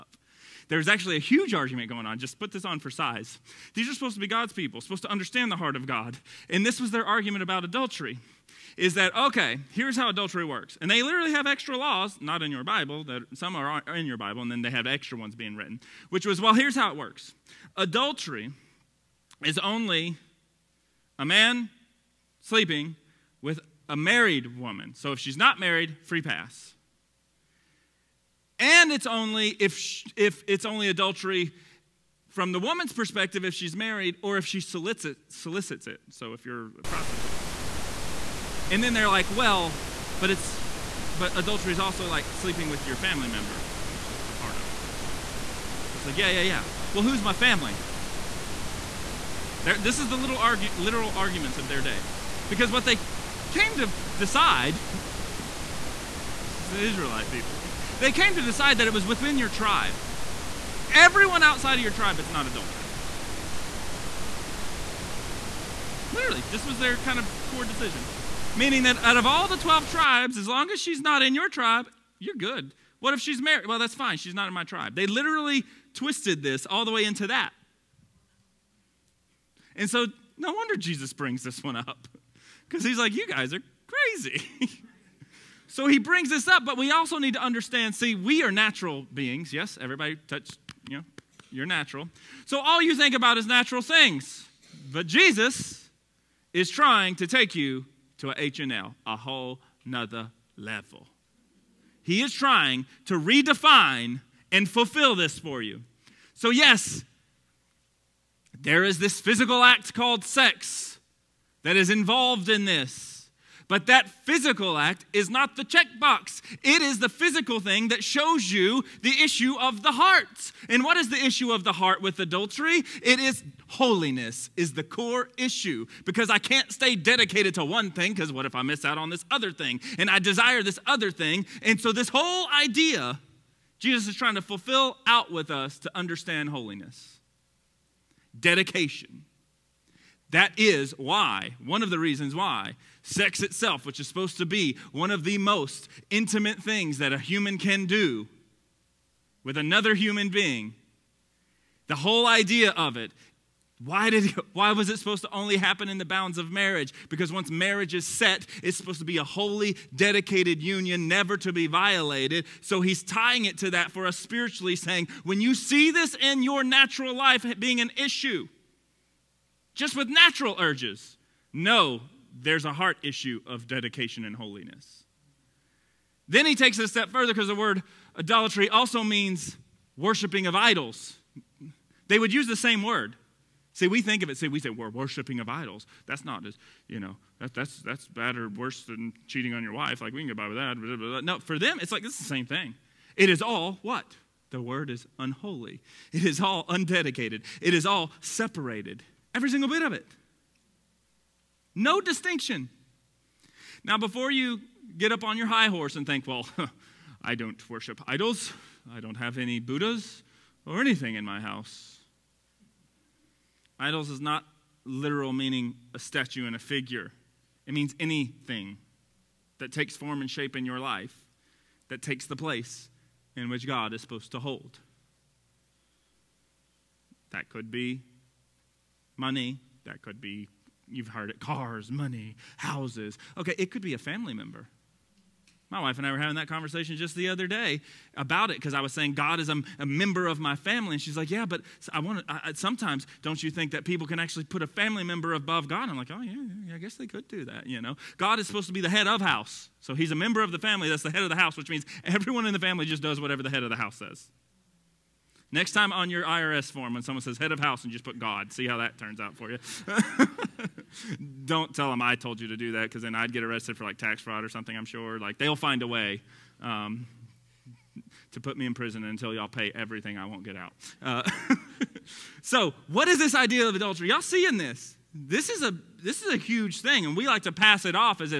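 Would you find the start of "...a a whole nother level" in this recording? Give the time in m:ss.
1:39.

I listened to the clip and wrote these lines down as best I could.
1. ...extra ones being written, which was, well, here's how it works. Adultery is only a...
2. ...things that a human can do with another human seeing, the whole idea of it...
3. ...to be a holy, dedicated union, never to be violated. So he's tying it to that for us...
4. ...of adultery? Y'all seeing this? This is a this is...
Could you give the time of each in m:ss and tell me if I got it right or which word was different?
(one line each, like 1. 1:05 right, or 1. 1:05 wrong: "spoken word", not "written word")
1. 0:14 right
2. 2:26 wrong: "being", not "seeing"
3. 2:38 right
4. 4:33 right.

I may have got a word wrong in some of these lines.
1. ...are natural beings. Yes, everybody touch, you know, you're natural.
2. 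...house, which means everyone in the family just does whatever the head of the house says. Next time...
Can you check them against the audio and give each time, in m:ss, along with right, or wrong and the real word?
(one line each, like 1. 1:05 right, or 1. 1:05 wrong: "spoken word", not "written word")
1. 1:28 right
2. 4:11 right.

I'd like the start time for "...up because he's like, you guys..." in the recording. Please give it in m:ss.
1:21.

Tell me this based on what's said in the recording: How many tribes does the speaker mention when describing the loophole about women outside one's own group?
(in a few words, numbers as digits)
12.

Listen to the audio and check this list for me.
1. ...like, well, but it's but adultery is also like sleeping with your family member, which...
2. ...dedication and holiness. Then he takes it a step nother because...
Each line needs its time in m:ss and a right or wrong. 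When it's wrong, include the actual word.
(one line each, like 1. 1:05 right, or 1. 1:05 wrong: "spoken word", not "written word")
1. 0:39 right
2. 2:53 wrong: "further", not "nother".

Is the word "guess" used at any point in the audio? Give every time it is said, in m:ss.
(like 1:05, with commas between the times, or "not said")
4:06.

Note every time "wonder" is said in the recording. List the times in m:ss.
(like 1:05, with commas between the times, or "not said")
1:20.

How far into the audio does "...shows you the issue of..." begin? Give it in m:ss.
1:58.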